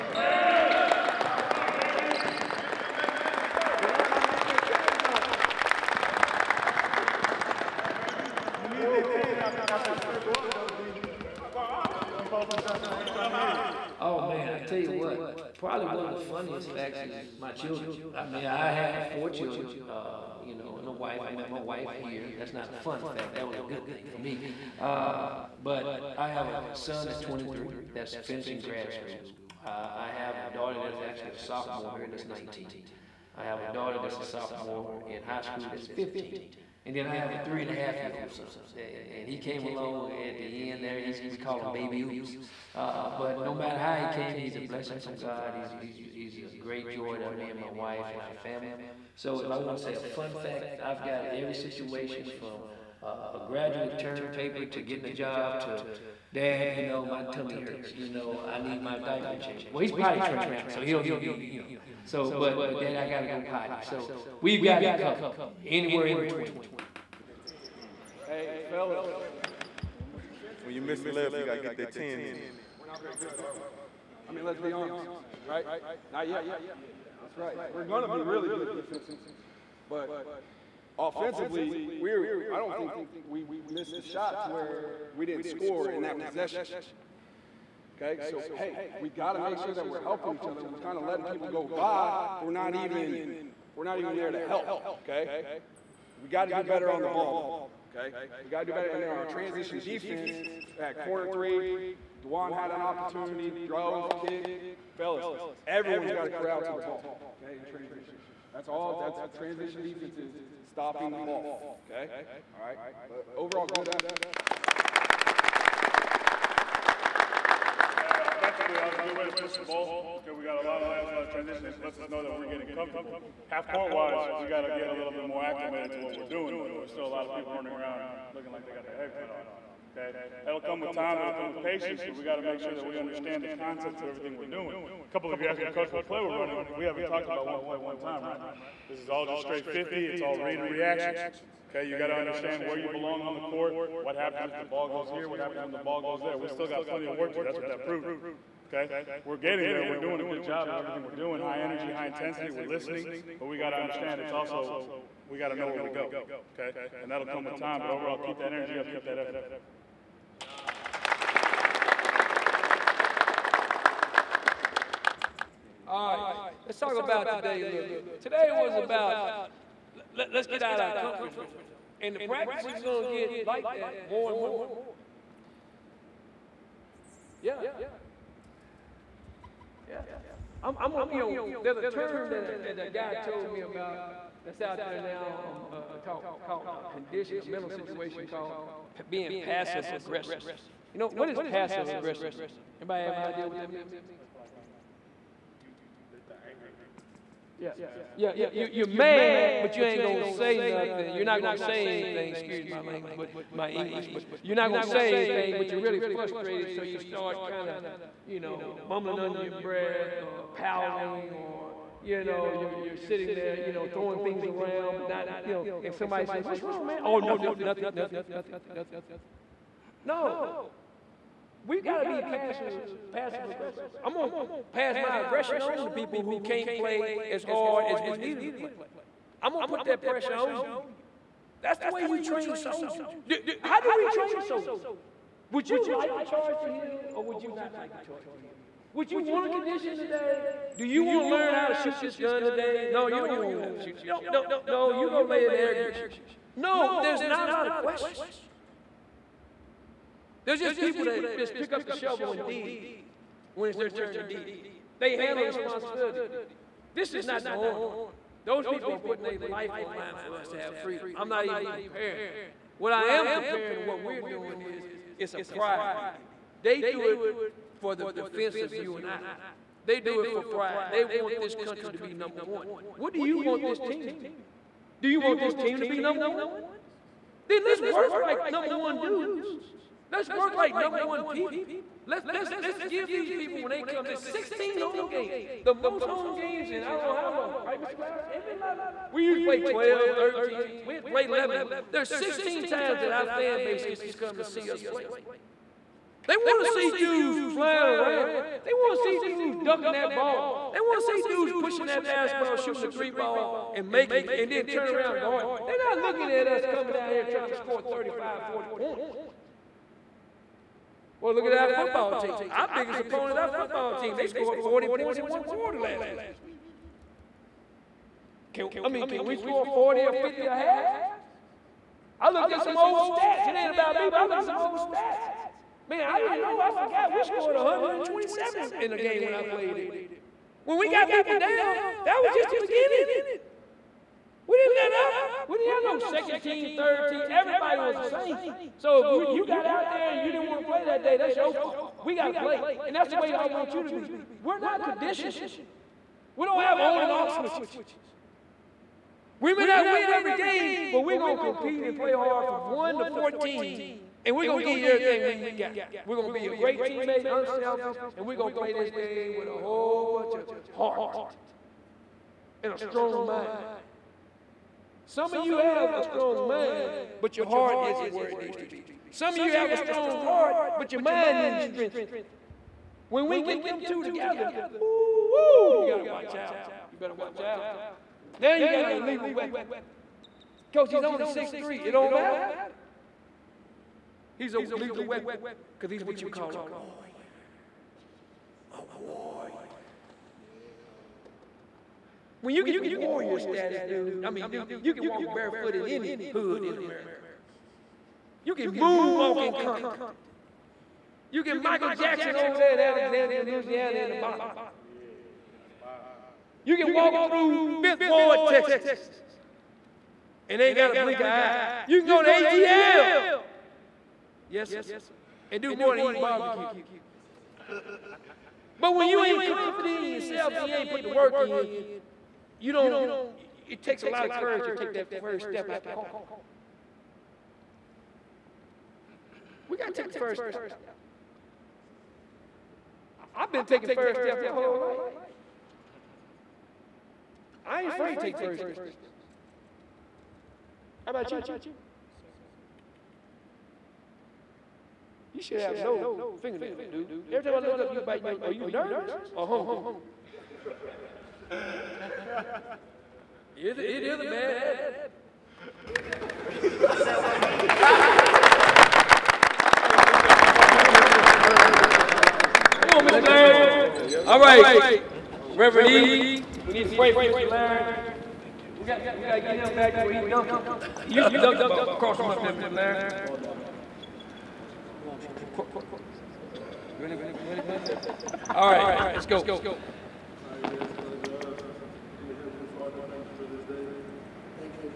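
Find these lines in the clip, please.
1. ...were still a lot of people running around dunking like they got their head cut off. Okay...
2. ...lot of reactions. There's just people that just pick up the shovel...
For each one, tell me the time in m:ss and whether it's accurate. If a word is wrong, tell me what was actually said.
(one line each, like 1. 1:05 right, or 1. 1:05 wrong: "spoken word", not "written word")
1. 2:06 wrong: "looking", not "dunking"
2. 4:07 wrong: "questions", not "reactions".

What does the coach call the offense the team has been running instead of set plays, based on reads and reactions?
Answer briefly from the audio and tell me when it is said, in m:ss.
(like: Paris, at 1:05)
straight 50, at 2:19.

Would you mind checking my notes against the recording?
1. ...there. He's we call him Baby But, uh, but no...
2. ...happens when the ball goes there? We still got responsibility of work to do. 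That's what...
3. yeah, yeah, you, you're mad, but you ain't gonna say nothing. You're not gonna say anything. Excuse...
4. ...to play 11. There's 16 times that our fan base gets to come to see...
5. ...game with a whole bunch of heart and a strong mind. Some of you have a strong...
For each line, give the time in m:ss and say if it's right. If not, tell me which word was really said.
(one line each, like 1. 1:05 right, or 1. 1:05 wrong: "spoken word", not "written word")
1. 0:40 wrong: "Oops", not "But"
2. 2:25 wrong: "plenty", not "responsibility"
3. 3:18 right
4. 4:51 right
5. 5:58 right.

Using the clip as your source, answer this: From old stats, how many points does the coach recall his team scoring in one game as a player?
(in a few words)
127.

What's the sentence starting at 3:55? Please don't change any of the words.
Would you like to charge to heal or would you not like to charge to heal?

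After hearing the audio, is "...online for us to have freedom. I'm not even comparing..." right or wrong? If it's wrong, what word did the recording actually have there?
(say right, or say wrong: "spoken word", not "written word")
right.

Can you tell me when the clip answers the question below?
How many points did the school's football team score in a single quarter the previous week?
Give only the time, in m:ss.
5:14.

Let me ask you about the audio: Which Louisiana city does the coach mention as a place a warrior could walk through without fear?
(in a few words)
Alexandria.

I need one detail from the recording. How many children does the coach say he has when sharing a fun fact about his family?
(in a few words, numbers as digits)
4.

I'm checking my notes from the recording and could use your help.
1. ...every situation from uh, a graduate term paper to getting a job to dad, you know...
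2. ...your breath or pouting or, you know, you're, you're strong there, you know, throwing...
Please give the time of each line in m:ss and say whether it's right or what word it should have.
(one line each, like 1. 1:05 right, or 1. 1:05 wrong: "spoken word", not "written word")
1. 0:51 right
2. 3:29 wrong: "sitting", not "strong".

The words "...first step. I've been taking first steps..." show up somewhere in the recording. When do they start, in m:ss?
7:10.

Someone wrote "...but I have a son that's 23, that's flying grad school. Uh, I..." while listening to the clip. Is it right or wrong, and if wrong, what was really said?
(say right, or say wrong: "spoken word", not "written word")
wrong: "finishing", not "flying".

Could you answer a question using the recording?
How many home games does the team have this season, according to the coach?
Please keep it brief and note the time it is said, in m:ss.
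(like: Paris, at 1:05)
16, at 4:44.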